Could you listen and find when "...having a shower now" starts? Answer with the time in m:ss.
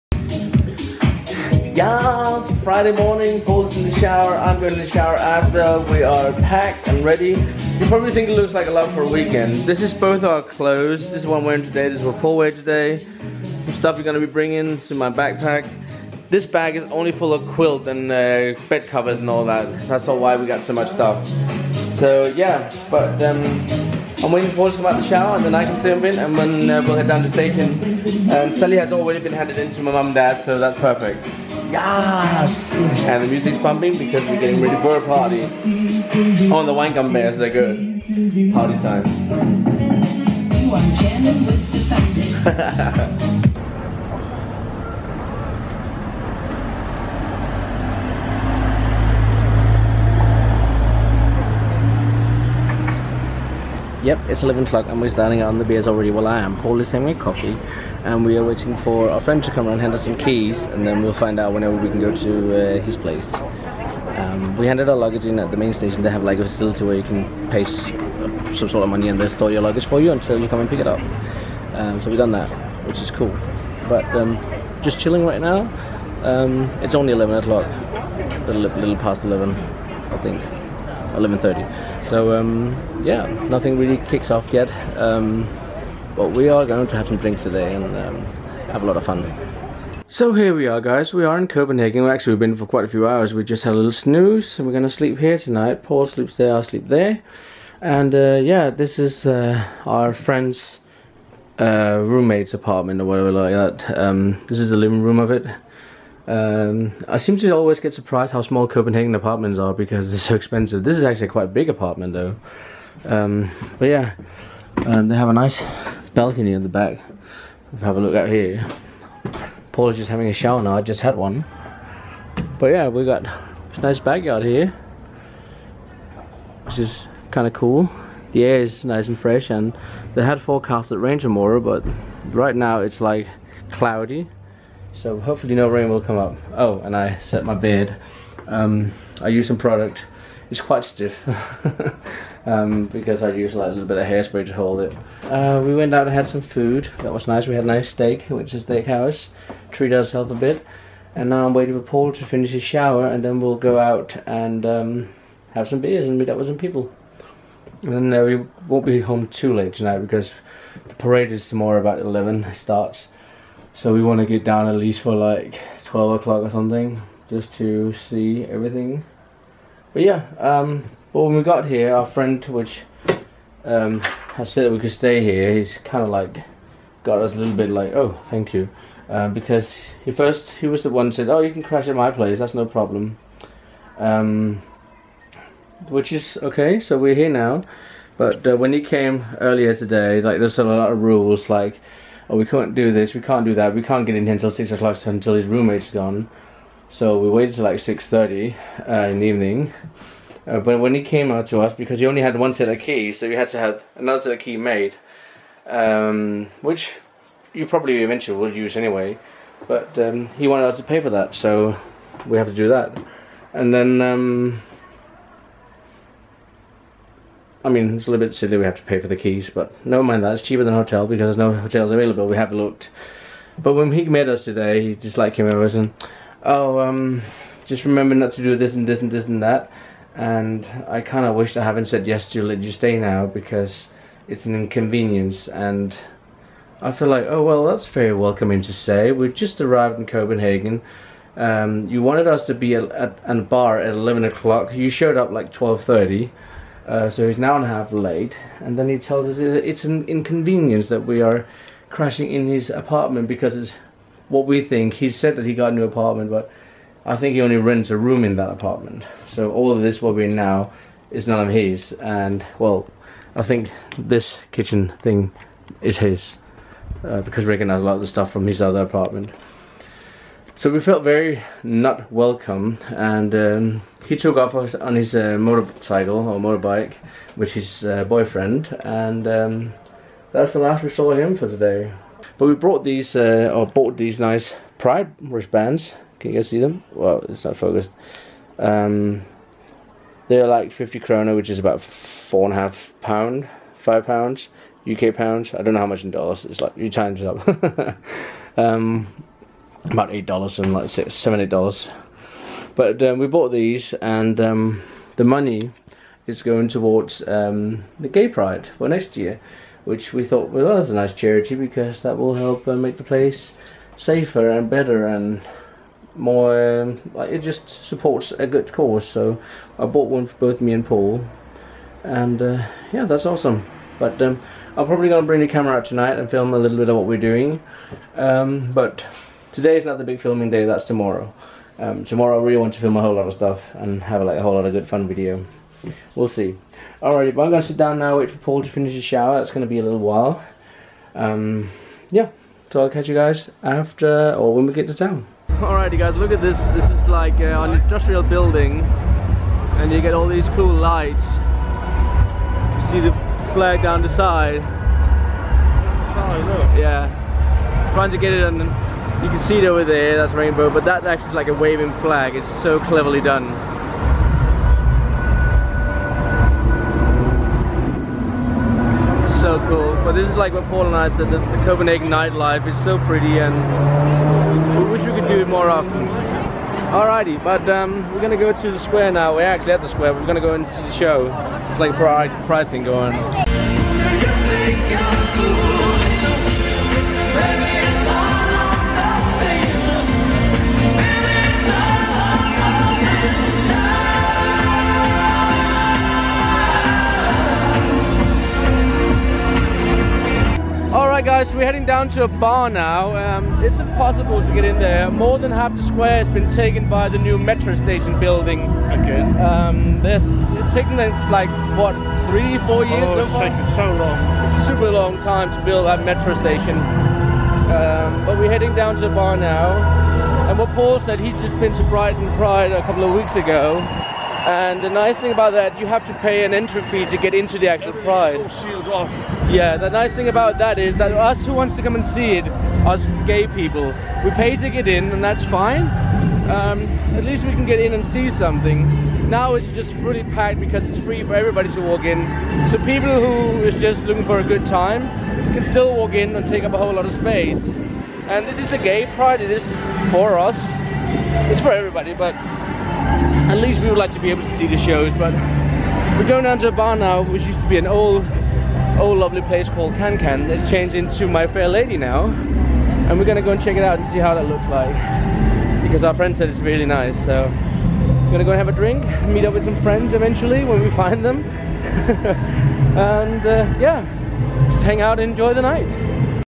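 2:00.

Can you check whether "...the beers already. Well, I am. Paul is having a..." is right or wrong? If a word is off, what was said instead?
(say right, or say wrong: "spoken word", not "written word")
right.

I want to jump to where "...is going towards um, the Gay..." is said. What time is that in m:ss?
5:06.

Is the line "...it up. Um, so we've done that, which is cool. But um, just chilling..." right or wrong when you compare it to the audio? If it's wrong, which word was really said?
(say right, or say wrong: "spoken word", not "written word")
right.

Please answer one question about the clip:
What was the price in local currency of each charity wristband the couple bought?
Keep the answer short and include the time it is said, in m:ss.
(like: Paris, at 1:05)
50 krona, at 4:50.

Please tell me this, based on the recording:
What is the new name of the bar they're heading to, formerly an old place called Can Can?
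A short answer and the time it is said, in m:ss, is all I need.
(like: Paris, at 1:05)
My Fair Lady, at 7:41.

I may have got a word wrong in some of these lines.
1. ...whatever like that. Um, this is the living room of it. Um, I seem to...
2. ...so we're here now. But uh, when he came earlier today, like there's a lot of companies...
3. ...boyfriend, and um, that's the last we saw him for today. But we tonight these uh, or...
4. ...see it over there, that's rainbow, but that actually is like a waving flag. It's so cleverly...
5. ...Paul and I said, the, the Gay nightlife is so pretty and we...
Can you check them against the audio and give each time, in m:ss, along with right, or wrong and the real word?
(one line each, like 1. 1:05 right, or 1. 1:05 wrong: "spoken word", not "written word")
1. 1:43 right
2. 3:06 wrong: "rules", not "companies"
3. 4:38 wrong: "brought", not "tonight"
4. 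5:59 right
5. 6:10 wrong: "Copenhagen", not "Gay".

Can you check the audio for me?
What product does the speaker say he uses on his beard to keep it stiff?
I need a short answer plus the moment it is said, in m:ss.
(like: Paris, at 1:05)
Hairspray, at 2:24.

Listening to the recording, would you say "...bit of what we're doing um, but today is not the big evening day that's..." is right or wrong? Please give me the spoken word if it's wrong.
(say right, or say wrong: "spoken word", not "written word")
wrong: "filming", not "evening".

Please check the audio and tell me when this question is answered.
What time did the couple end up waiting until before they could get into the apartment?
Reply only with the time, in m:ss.
3:17.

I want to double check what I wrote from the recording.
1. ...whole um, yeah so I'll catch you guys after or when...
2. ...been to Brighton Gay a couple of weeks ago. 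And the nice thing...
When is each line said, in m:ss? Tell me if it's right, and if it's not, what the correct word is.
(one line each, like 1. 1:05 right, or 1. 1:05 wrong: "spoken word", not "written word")
1. 5:39 wrong: "while", not "whole"
2. 7:01 wrong: "Pride", not "Gay".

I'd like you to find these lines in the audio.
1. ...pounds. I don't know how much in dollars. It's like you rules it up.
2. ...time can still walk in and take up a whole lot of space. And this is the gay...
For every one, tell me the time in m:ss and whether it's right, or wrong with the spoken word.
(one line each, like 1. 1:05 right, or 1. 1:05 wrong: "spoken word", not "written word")
1. 4:55 wrong: "times", not "rules"
2. 7:24 right.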